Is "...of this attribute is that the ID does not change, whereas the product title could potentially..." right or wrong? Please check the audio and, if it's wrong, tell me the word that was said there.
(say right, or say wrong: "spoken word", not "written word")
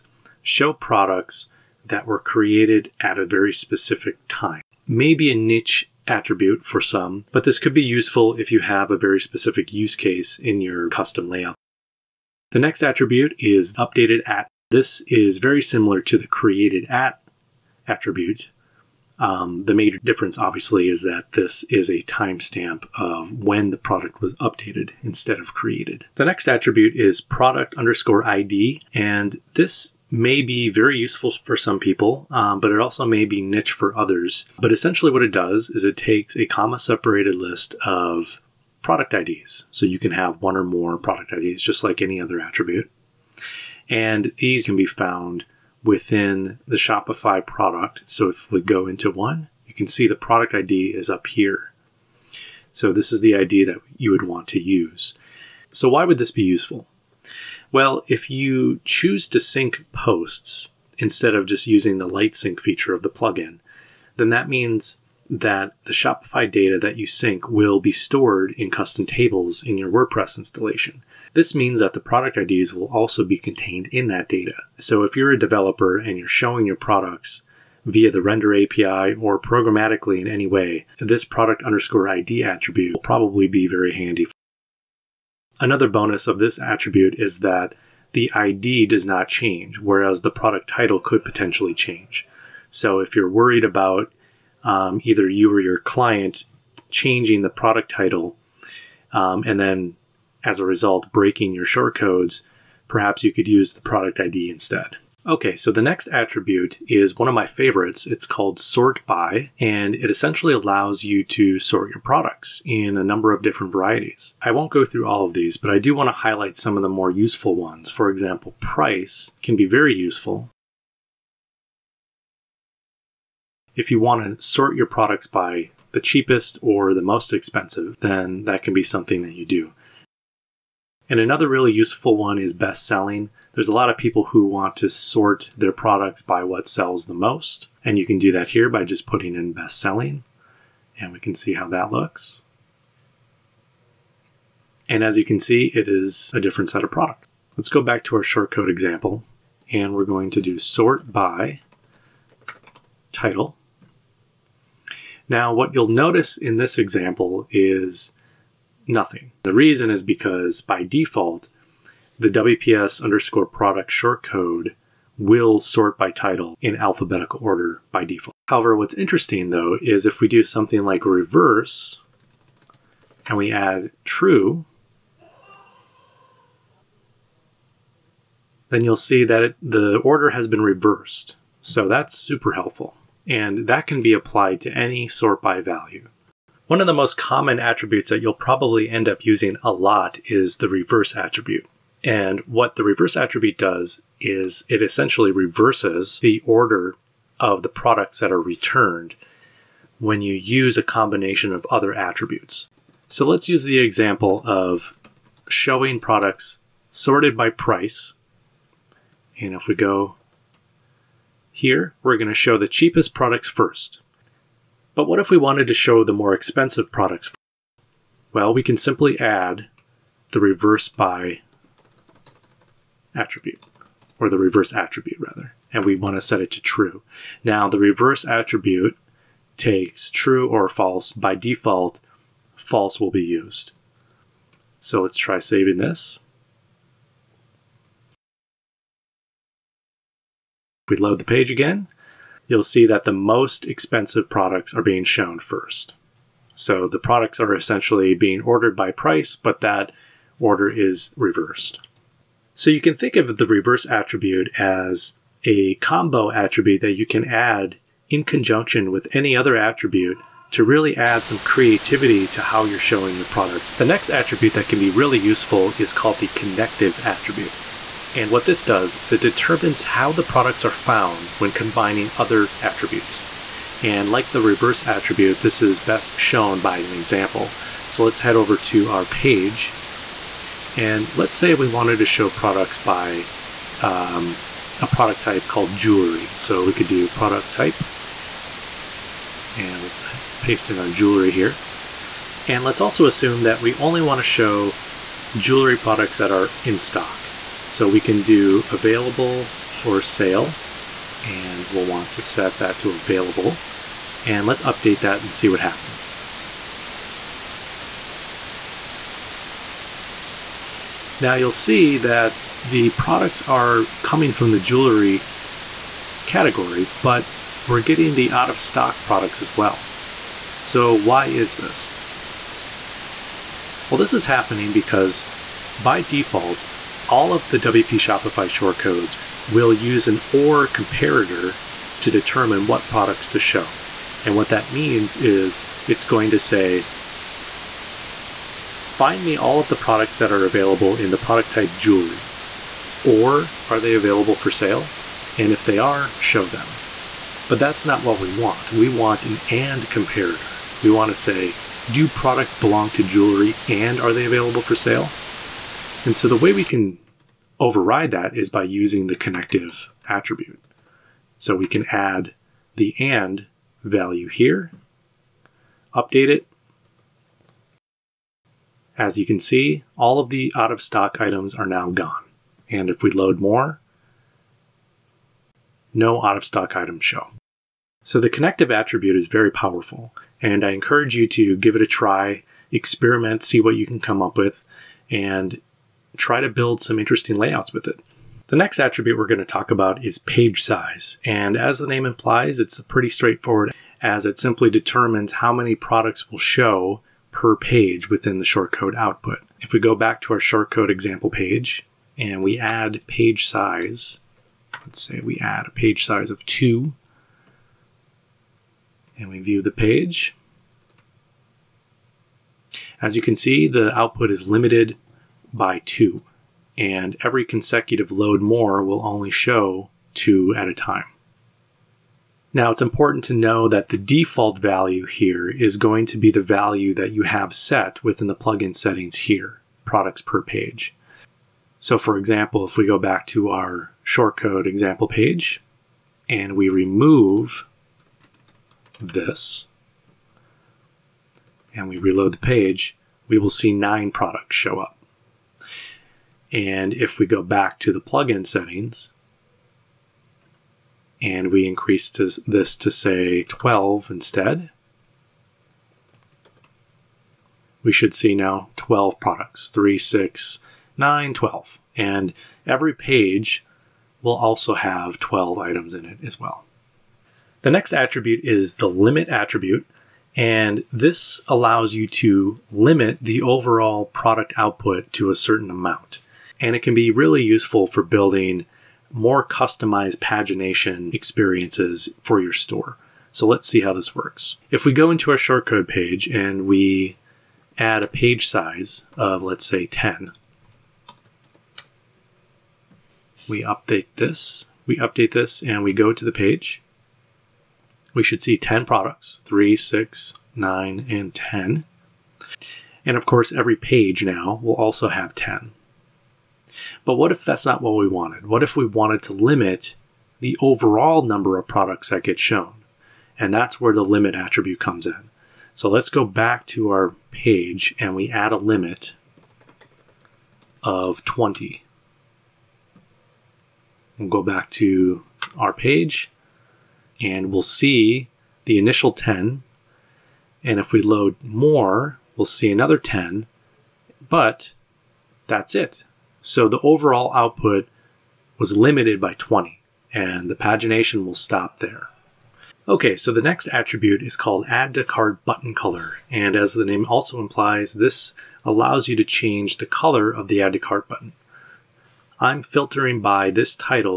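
right.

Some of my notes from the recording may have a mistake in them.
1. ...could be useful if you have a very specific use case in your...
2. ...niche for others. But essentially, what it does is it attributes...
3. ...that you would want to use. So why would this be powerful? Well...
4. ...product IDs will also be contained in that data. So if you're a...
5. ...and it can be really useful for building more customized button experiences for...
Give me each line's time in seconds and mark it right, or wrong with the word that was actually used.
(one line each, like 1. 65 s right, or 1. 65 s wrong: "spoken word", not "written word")
1. 7 s right
2. 33 s wrong: "takes", not "attributes"
3. 53 s wrong: "useful", not "powerful"
4. 72 s right
5. 476 s wrong: "pagination", not "button".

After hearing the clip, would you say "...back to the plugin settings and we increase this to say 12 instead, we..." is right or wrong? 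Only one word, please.
right.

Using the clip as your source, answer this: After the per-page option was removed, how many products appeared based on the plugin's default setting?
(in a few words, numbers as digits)
9.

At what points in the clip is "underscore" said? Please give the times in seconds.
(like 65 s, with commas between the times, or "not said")
27 s, 81 s, 163 s.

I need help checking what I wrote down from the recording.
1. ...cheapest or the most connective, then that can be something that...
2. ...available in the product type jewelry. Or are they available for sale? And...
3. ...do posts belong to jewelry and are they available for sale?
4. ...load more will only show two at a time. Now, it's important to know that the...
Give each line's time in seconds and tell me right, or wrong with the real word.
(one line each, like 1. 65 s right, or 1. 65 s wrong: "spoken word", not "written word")
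1. 126 s wrong: "expensive", not "connective"
2. 340 s right
3. 351 s wrong: "products", not "posts"
4. 418 s right.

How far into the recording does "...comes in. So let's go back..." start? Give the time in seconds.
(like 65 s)
514 s.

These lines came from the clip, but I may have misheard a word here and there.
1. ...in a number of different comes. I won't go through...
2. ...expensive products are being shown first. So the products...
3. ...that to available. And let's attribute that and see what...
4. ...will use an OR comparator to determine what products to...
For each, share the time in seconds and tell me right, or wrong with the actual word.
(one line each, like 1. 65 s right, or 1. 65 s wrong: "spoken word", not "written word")
1. 112 s wrong: "varieties", not "comes"
2. 243 s right
3. 302 s wrong: "update", not "attribute"
4. 329 s right.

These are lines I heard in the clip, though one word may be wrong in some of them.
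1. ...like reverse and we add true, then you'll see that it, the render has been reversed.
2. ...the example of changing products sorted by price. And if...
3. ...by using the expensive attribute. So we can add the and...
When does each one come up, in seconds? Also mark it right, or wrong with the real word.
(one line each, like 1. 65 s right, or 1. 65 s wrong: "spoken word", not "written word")
1. 170 s wrong: "order", not "render"
2. 203 s wrong: "showing", not "changing"
3. 358 s wrong: "connective", not "expensive".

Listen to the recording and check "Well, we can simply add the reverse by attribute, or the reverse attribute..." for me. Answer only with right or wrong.
right.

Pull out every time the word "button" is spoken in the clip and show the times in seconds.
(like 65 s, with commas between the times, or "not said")
545 s, 551 s.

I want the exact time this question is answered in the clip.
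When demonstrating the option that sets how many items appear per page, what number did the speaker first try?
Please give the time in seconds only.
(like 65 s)
406 s.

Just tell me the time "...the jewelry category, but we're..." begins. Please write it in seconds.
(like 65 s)
314 s.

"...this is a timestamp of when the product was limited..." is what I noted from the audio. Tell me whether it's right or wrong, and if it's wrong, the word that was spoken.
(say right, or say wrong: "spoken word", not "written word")
wrong: "updated", not "limited".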